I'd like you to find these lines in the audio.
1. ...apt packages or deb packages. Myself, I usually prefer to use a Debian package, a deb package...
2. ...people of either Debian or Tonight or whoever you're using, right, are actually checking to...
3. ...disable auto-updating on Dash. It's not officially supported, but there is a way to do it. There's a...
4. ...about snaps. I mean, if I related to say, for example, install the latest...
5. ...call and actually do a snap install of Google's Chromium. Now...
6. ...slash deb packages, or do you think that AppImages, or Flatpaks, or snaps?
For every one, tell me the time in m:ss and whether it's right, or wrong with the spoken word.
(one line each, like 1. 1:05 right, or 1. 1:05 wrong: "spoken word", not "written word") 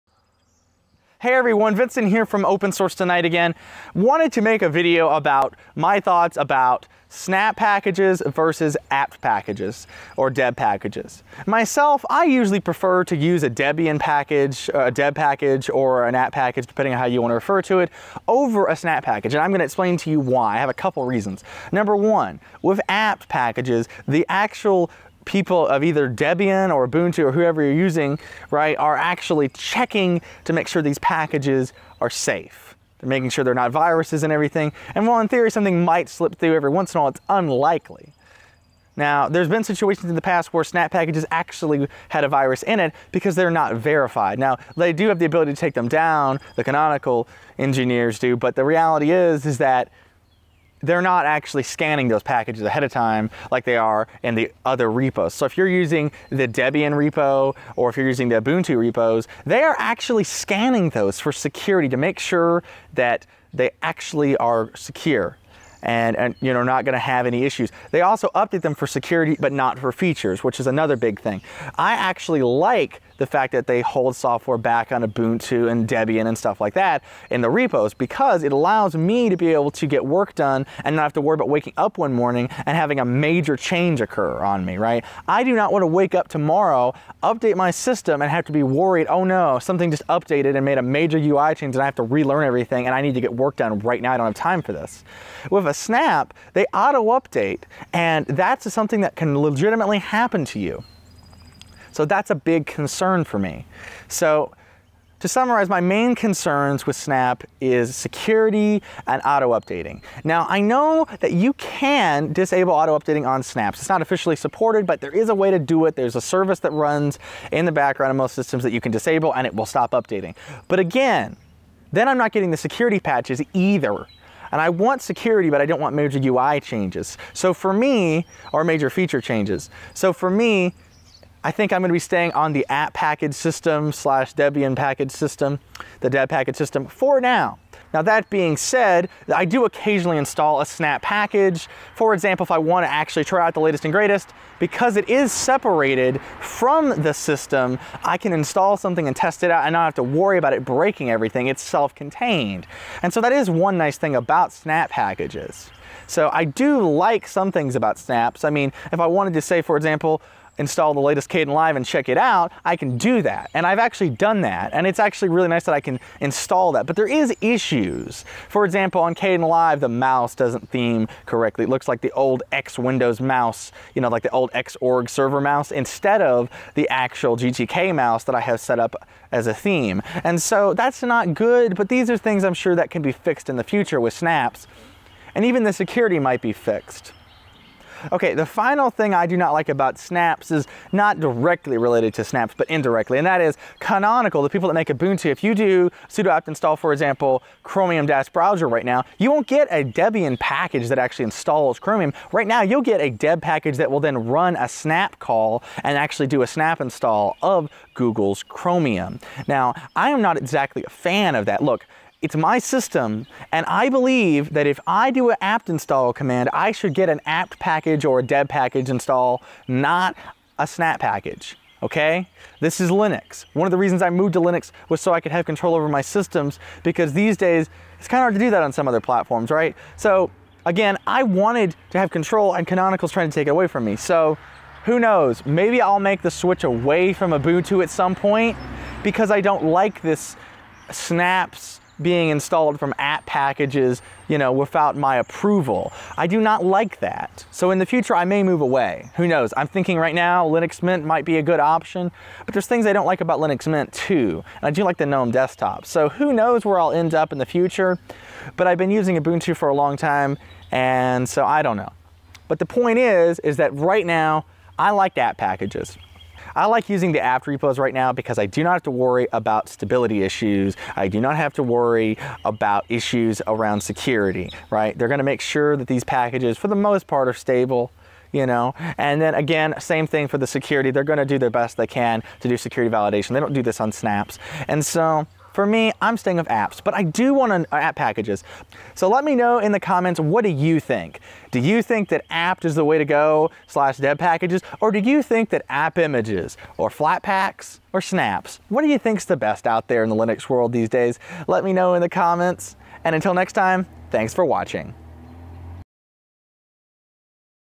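1. 0:08 right
2. 0:25 wrong: "Ubuntu", not "Tonight"
3. 1:52 wrong: "Snaps", not "Dash"
4. 2:37 wrong: "wanted", not "related"
5. 3:25 right
6. 4:53 right.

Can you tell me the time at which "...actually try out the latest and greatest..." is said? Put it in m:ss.
2:22.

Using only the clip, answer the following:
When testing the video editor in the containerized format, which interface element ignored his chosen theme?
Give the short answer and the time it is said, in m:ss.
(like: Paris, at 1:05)
the mouse, at 2:49.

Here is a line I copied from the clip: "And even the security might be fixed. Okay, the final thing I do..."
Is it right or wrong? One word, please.
right.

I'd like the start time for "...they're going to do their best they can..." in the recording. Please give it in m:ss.
4:40.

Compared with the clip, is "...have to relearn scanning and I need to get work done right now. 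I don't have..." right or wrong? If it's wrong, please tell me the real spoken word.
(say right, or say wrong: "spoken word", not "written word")
wrong: "everything", not "scanning".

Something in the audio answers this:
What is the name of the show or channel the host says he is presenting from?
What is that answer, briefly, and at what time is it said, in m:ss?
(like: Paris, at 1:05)
Open Source Tonight, at 0:02.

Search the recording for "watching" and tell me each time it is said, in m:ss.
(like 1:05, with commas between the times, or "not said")
5:04.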